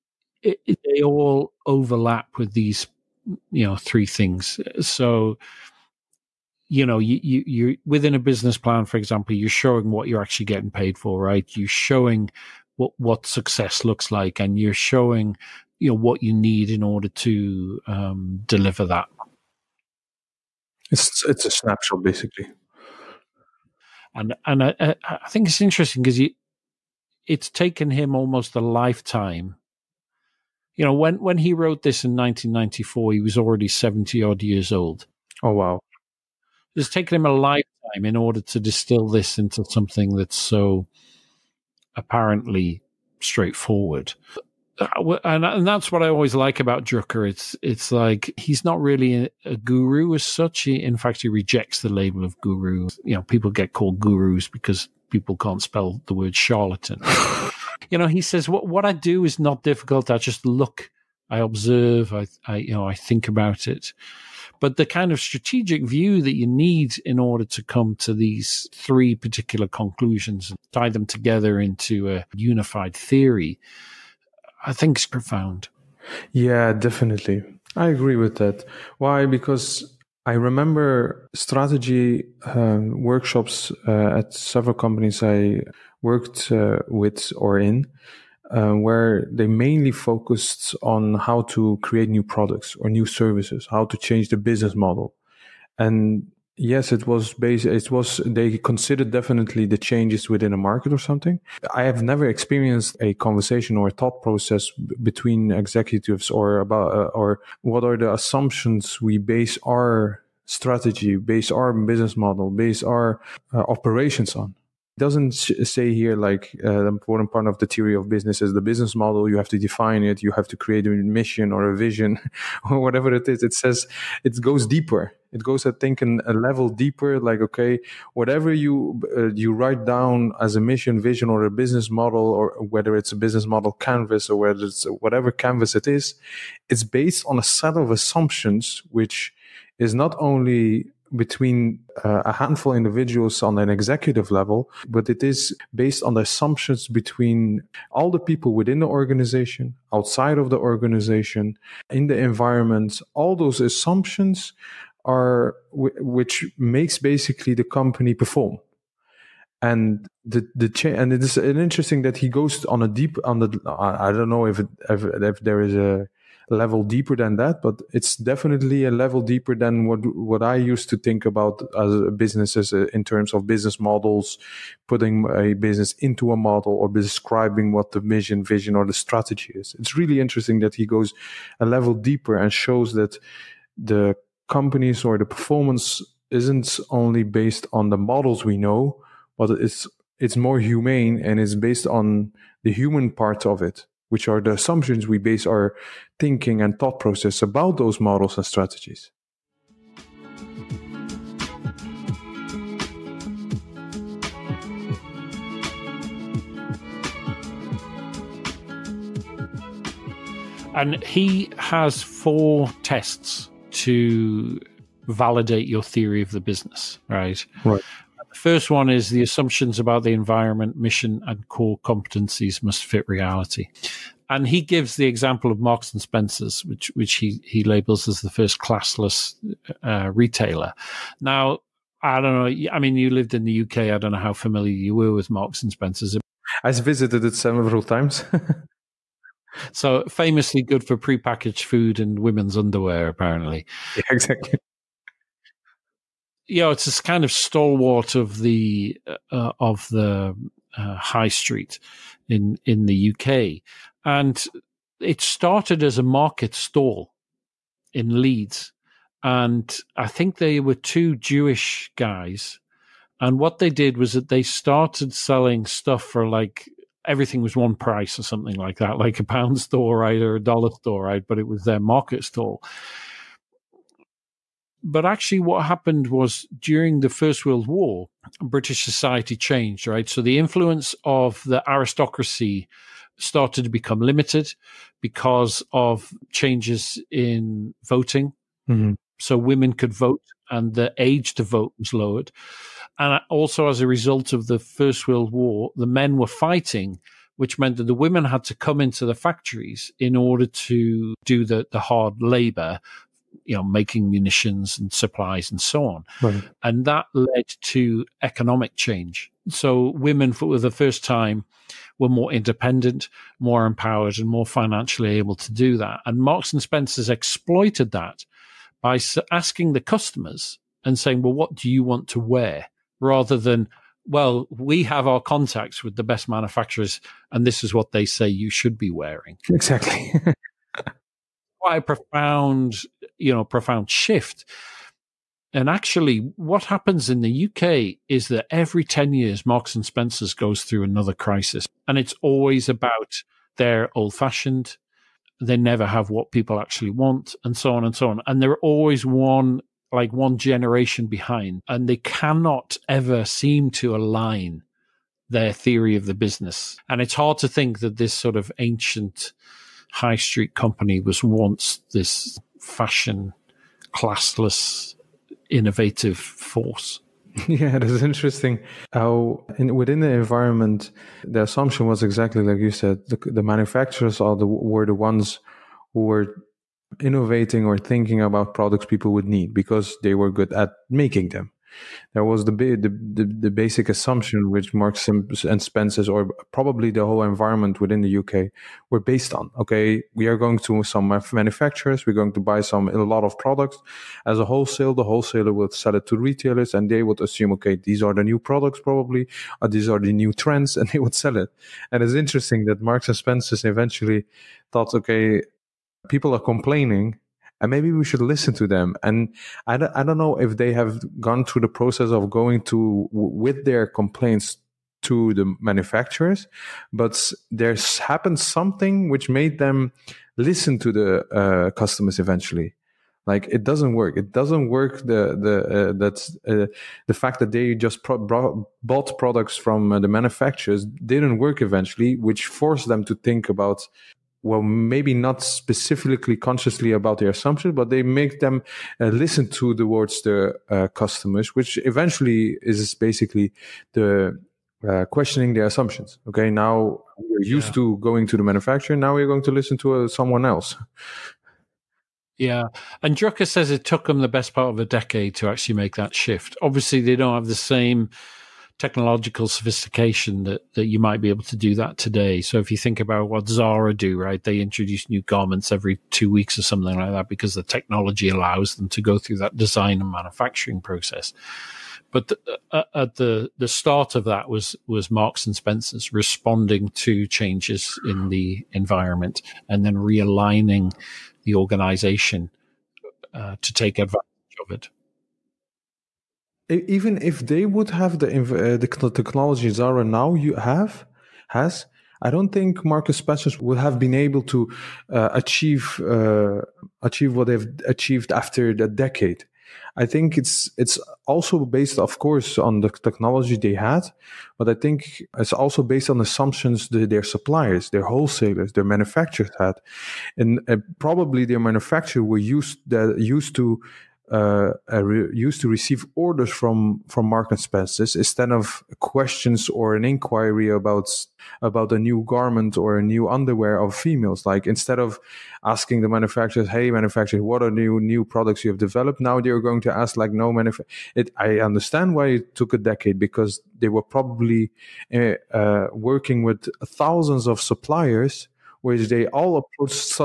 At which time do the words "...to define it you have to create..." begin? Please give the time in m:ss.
1:59.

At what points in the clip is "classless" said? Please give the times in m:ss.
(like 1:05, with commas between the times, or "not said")
3:48, 6:03.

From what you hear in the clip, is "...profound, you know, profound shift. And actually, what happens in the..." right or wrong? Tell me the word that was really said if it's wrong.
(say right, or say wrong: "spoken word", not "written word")
right.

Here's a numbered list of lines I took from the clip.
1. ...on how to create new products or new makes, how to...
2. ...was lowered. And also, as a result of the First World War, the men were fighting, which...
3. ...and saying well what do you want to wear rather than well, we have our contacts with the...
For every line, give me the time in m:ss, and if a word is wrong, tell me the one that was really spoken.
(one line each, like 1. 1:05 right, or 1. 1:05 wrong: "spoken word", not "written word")
1. 1:30 wrong: "services", not "makes"
2. 4:51 right
3. 5:20 right.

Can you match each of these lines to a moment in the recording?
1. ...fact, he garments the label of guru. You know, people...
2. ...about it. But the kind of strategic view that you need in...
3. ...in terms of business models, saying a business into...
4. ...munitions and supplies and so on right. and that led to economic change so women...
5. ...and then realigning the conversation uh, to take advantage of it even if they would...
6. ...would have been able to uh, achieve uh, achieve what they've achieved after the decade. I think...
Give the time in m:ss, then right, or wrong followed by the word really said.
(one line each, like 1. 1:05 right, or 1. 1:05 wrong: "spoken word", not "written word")
1. 0:50 wrong: "rejects", not "garments"
2. 1:03 right
3. 2:52 wrong: "putting", not "saying"
4. 5:04 right
5. 7:59 wrong: "organization", not "conversation"
6. 8:13 right.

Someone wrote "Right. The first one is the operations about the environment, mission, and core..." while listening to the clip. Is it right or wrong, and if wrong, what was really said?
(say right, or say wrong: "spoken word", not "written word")
wrong: "assumptions", not "operations".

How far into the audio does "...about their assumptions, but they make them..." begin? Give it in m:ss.
7:16.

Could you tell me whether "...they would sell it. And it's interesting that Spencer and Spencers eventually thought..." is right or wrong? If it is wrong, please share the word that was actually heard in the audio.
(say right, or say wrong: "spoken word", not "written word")
wrong: "Marks", not "Spencer".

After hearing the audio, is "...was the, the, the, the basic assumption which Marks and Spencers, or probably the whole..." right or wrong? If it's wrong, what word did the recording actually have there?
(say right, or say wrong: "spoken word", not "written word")
right.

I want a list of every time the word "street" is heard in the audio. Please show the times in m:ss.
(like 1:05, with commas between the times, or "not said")
4:11, 6:00.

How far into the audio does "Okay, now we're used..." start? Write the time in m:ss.
7:26.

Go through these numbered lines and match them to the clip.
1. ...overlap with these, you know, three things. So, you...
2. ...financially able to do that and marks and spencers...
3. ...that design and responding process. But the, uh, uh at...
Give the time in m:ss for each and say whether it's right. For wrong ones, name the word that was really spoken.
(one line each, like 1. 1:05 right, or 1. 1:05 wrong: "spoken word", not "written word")
1. 0:01 right
2. 5:14 right
3. 7:49 wrong: "manufacturing", not "responding".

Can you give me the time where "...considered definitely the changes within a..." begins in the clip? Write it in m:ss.
1:38.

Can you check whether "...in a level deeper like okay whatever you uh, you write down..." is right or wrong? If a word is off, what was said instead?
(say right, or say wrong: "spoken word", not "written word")
right.